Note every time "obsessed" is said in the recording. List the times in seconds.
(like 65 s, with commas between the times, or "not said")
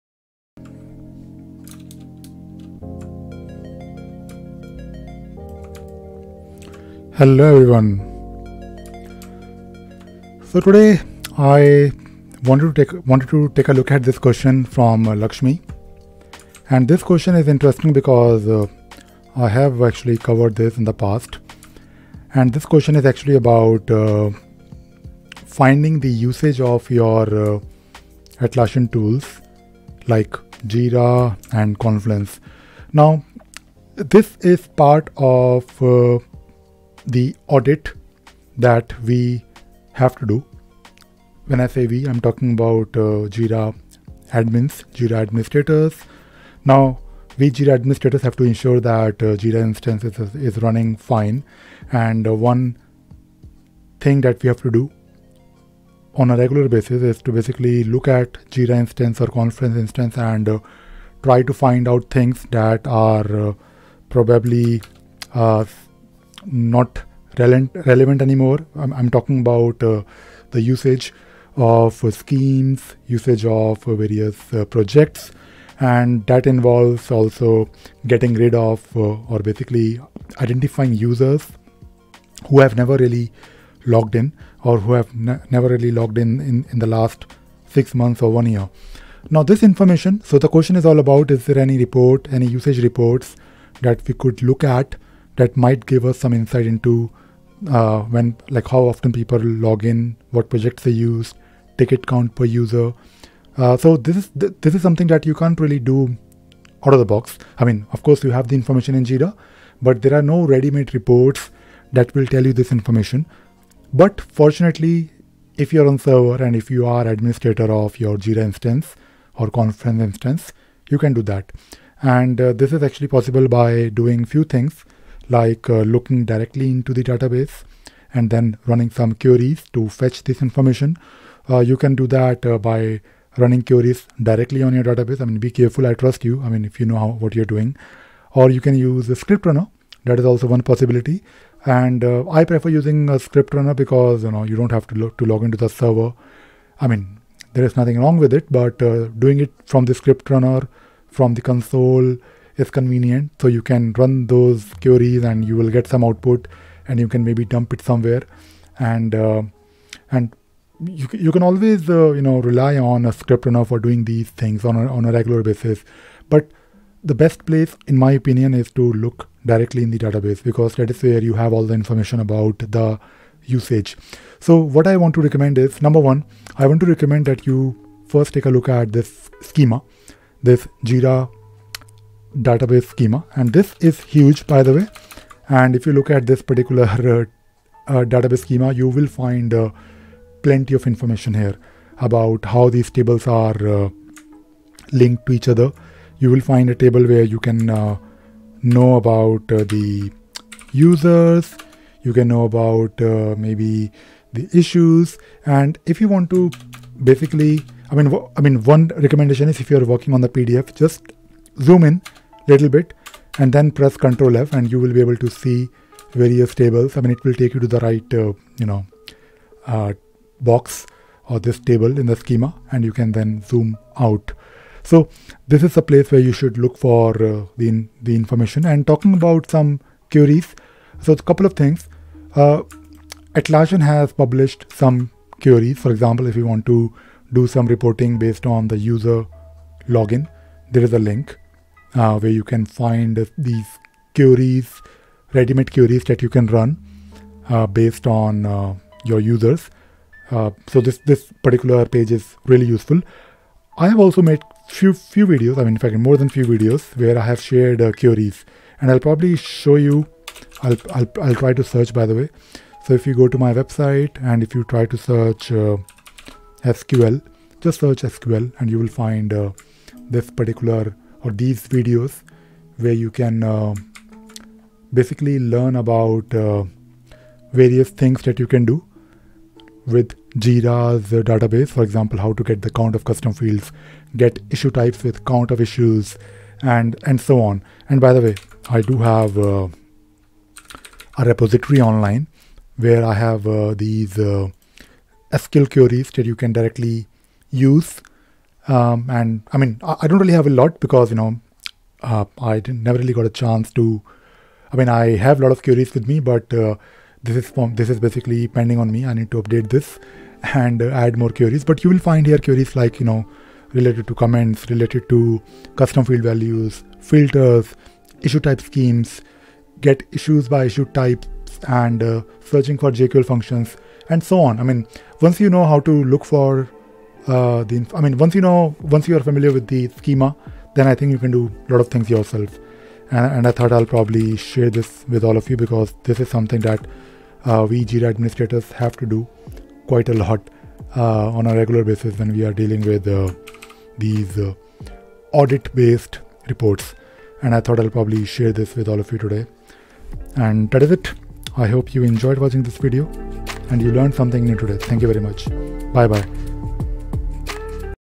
not said.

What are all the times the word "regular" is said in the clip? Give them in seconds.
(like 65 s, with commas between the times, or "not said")
56 s, 165 s, 341 s.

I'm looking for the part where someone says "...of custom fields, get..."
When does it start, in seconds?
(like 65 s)
282 s.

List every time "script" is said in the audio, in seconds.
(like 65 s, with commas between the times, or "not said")
139 s, 143 s, 149 s, 163 s.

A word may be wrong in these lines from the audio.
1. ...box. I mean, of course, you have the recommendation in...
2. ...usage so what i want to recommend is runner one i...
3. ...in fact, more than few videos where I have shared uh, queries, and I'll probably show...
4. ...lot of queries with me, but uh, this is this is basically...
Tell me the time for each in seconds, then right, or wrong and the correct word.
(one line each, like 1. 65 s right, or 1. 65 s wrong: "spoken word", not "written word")
1. 107 s wrong: "information", not "recommendation"
2. 173 s wrong: "number", not "runner"
3. 255 s right
4. 305 s right.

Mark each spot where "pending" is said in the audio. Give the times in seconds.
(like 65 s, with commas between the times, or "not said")
308 s.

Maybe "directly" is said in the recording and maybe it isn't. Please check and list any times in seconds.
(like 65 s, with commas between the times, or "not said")
126 s, 134 s, 169 s, 296 s.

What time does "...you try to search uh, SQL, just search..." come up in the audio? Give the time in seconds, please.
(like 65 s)
264 s.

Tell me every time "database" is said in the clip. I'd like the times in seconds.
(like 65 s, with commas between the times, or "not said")
127 s, 134 s, 169 s, 182 s, 188 s, 281 s.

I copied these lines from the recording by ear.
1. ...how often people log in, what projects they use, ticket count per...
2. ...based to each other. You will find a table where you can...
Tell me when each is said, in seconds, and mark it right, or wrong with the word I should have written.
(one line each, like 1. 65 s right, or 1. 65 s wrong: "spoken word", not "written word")
1. 98 s right
2. 194 s wrong: "linked", not "based".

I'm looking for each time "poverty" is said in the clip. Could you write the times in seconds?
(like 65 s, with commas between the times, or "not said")
not said.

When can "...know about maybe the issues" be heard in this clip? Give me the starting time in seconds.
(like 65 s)
202 s.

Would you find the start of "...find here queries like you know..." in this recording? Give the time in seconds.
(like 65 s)
311 s.